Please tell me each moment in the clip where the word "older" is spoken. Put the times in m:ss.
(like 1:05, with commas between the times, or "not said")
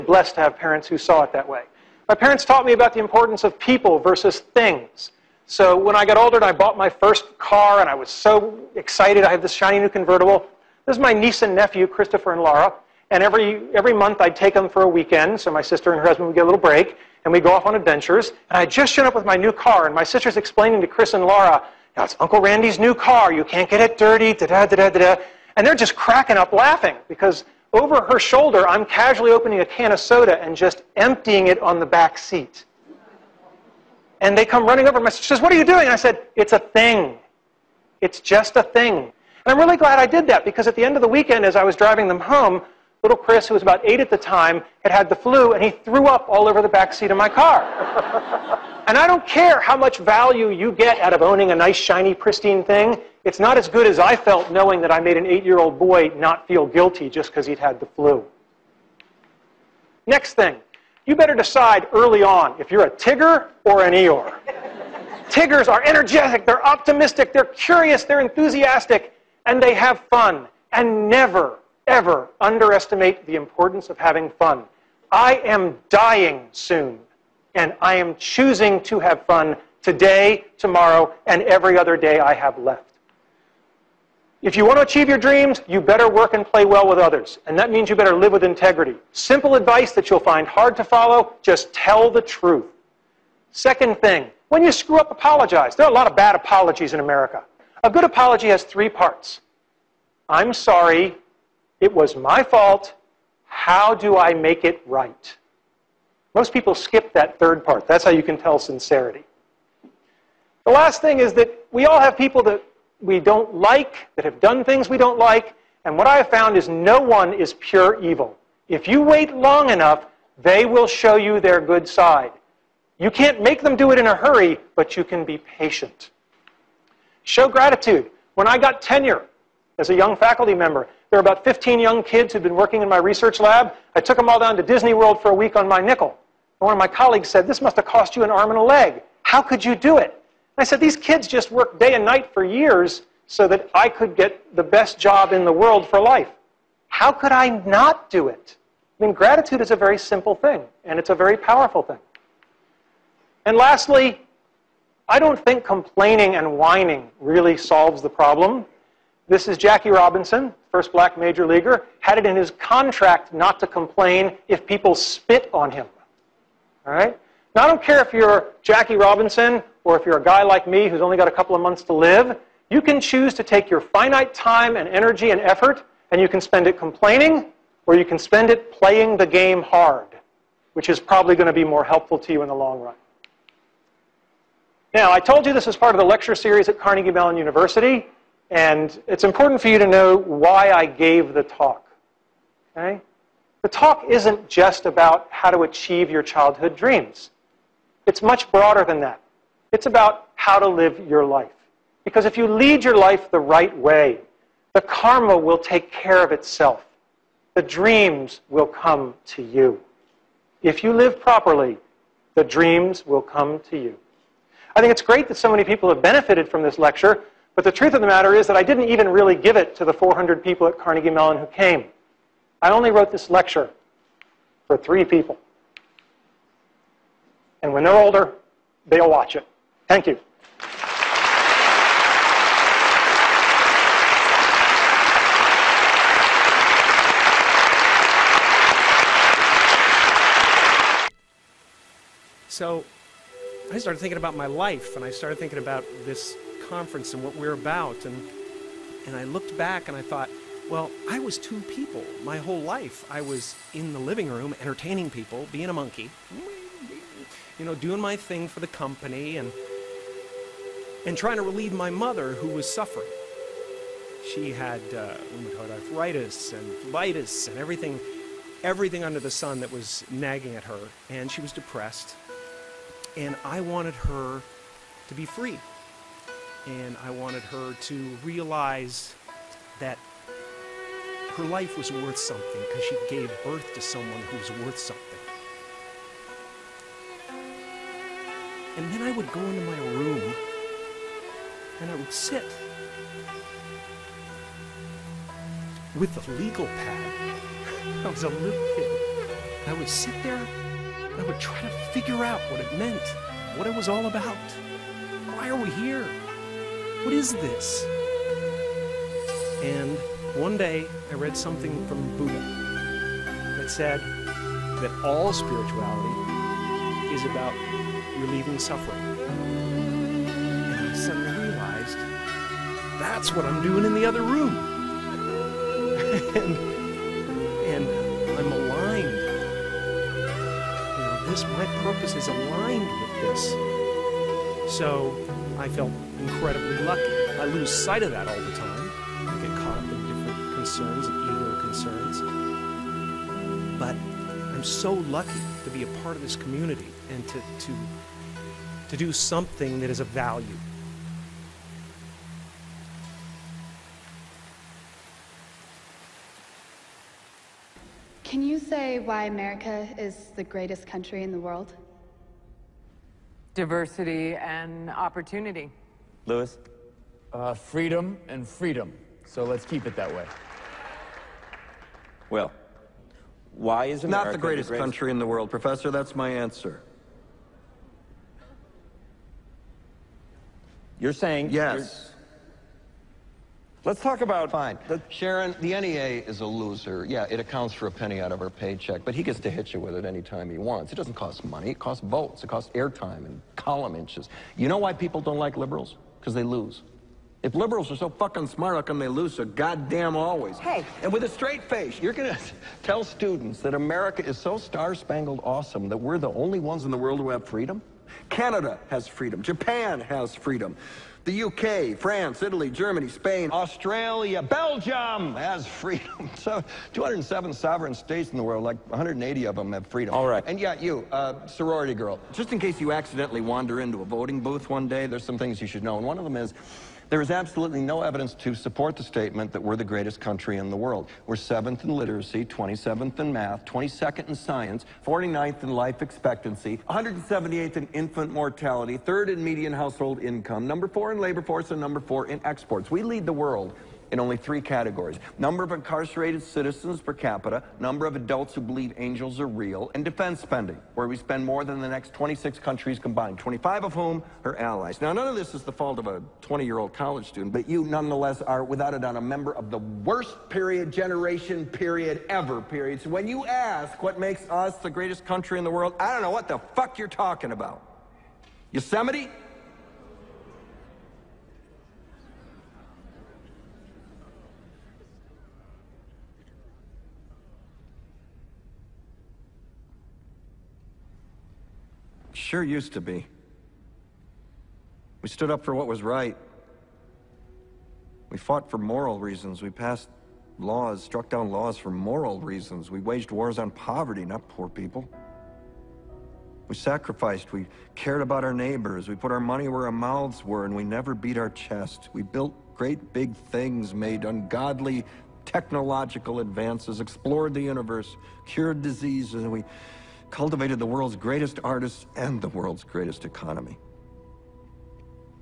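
0:06, 3:47.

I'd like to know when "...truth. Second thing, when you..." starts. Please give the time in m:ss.
1:32.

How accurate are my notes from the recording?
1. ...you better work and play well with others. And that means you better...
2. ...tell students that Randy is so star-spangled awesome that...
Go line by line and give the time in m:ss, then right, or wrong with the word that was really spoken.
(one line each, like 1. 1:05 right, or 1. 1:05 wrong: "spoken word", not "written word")
1. 1:25 right
2. 6:42 wrong: "America", not "Randy".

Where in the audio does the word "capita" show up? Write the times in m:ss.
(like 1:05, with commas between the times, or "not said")
7:27.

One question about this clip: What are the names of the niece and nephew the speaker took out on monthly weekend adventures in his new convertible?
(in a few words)
Christopher and Laura.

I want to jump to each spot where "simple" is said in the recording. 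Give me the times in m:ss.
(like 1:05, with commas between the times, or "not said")
1:29, 2:29.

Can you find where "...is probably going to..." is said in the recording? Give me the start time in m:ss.
3:00.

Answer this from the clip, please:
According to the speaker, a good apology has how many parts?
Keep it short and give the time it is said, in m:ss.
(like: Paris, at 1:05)
3, at 1:38.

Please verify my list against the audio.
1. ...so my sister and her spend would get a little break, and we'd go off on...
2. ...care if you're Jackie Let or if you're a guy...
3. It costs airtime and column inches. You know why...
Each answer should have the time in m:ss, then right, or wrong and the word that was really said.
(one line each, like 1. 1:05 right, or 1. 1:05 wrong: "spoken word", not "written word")
1. 0:15 wrong: "husband", not "spend"
2. 2:47 wrong: "Robinson", not "Let"
3. 6:32 right.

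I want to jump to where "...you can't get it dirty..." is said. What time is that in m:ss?
0:23.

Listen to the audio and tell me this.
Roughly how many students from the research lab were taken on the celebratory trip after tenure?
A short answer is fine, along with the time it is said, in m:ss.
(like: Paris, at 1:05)
15, at 2:11.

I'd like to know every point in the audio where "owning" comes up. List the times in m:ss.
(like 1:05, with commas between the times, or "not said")
0:51.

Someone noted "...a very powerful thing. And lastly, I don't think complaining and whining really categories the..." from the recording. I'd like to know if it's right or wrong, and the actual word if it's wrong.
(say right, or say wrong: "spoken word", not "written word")
wrong: "solves", not "categories".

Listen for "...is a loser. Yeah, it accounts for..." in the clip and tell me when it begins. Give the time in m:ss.
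6:26.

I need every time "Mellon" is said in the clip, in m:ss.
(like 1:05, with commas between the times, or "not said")
3:07, 3:41.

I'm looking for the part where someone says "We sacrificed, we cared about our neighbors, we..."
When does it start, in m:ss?
8:16.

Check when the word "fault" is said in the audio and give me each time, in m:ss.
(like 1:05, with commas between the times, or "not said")
1:42, 7:35.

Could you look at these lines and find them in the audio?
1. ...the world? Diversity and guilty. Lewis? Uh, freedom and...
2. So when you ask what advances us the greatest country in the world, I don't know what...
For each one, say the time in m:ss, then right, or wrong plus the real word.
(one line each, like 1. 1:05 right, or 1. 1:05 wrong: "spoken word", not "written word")
1. 6:01 wrong: "opportunity", not "guilty"
2. 7:43 wrong: "makes", not "advances".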